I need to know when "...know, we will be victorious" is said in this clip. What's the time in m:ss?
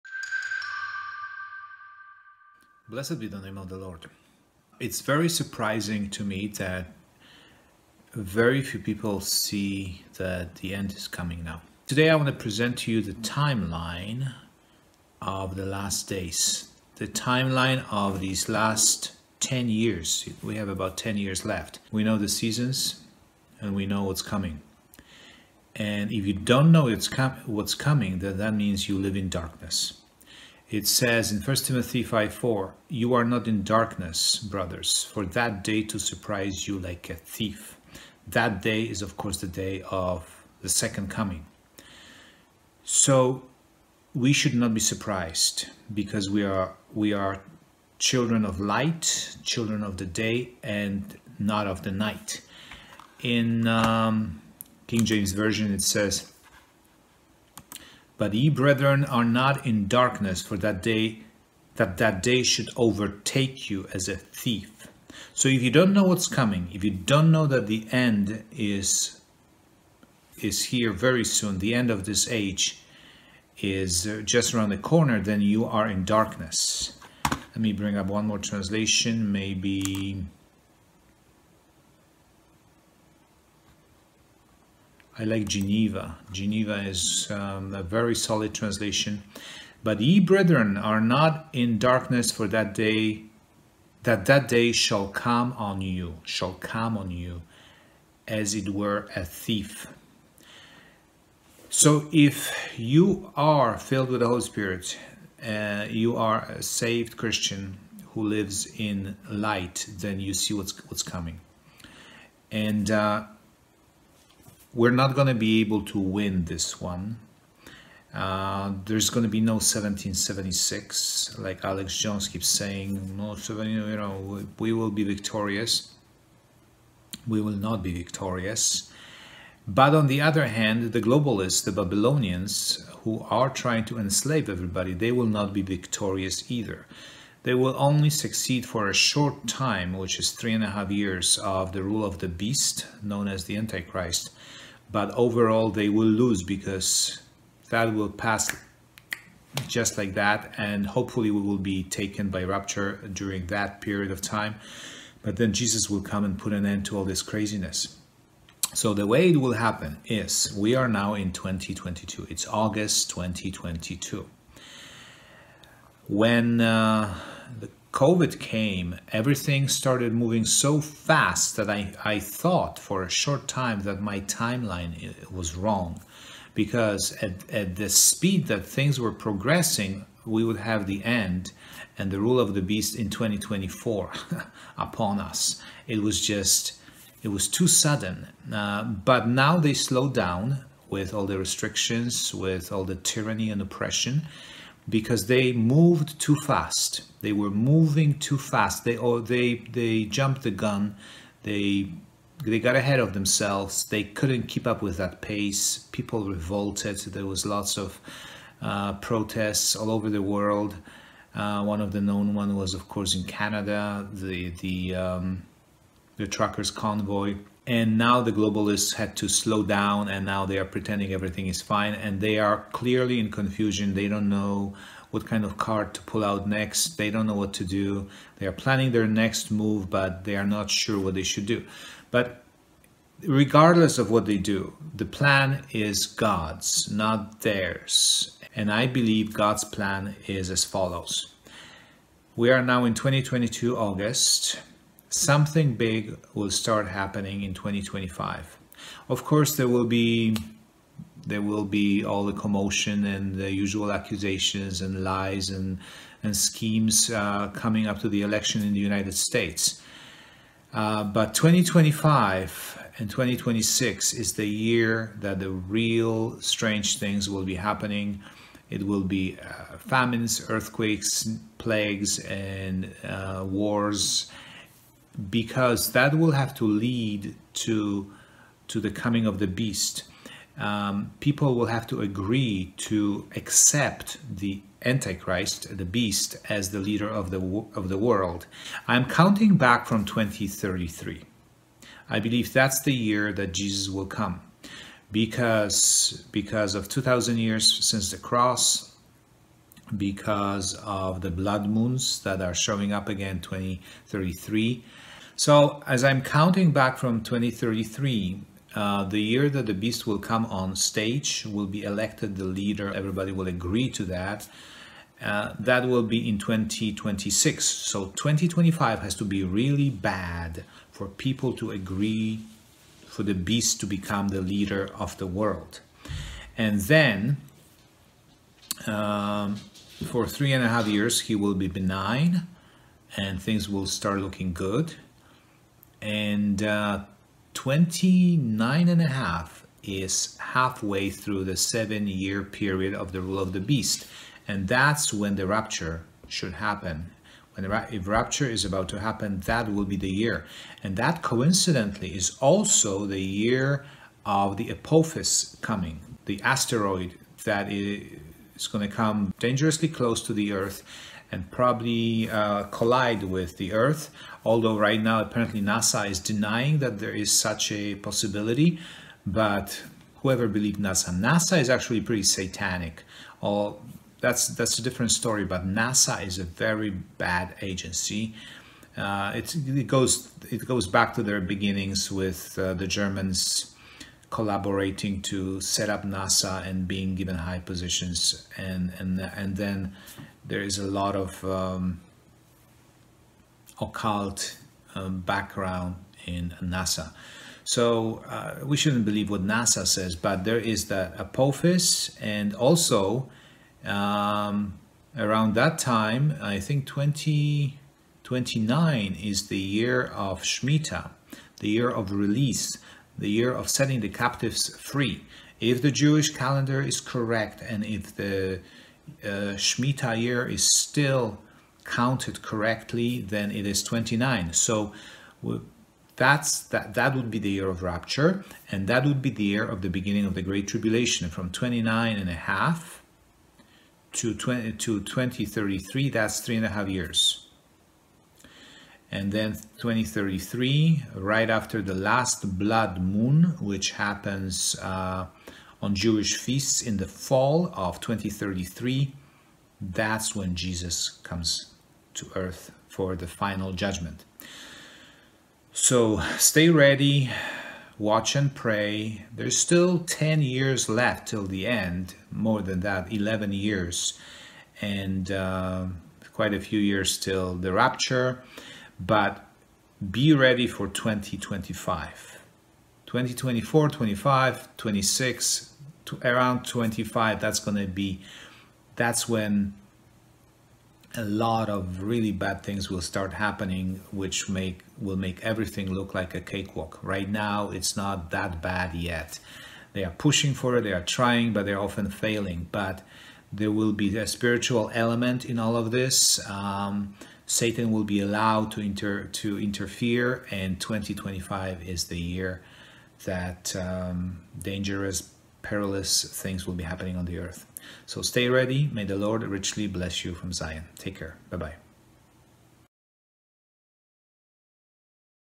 2:03.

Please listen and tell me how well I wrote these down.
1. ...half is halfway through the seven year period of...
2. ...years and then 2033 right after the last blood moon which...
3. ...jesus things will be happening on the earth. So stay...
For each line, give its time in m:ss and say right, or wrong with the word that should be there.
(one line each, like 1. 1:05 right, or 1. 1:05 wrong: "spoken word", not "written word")
1. 5:39 right
2. 7:16 right
3. 8:25 wrong: "perilous", not "jesus".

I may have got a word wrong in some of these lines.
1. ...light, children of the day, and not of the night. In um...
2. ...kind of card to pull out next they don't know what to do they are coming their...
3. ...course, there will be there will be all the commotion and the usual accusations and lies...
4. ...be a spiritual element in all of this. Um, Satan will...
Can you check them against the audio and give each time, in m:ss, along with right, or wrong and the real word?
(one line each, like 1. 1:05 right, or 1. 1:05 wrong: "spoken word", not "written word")
1. 0:48 right
2. 3:45 wrong: "planning", not "coming"
3. 4:09 right
4. 8:13 right.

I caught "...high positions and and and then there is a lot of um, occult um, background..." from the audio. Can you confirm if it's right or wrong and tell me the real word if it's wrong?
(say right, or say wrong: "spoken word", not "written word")
right.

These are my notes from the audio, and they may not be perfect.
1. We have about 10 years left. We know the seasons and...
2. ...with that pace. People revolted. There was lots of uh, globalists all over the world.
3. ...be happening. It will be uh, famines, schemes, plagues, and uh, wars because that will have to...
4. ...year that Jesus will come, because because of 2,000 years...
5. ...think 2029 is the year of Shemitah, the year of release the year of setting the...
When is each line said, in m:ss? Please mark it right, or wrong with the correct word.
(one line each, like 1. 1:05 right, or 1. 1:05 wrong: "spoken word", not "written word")
1. 0:20 right
2. 3:24 wrong: "protests", not "globalists"
3. 4:27 wrong: "earthquakes", not "schemes"
4. 4:52 right
5. 6:46 right.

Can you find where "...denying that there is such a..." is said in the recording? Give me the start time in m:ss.
6:06.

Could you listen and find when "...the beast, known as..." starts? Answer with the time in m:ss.
2:22.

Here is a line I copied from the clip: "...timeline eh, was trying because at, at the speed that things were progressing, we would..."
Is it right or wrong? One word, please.
wrong.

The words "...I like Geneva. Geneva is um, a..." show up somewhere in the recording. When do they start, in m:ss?
1:25.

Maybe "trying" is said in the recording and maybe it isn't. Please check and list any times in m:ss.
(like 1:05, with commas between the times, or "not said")
2:13, 8:11.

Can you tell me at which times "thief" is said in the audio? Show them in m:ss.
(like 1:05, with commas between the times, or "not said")
0:37, 1:04, 1:39.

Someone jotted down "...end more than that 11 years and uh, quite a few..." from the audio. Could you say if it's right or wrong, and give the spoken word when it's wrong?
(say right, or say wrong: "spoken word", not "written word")
right.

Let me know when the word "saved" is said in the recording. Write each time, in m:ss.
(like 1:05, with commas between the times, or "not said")
1:46.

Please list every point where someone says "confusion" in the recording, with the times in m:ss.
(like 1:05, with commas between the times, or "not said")
3:43.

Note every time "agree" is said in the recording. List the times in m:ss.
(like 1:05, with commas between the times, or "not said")
4:42, 5:13, 5:21.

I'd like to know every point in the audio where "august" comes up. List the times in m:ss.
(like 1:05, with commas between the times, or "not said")
2:42, 4:03.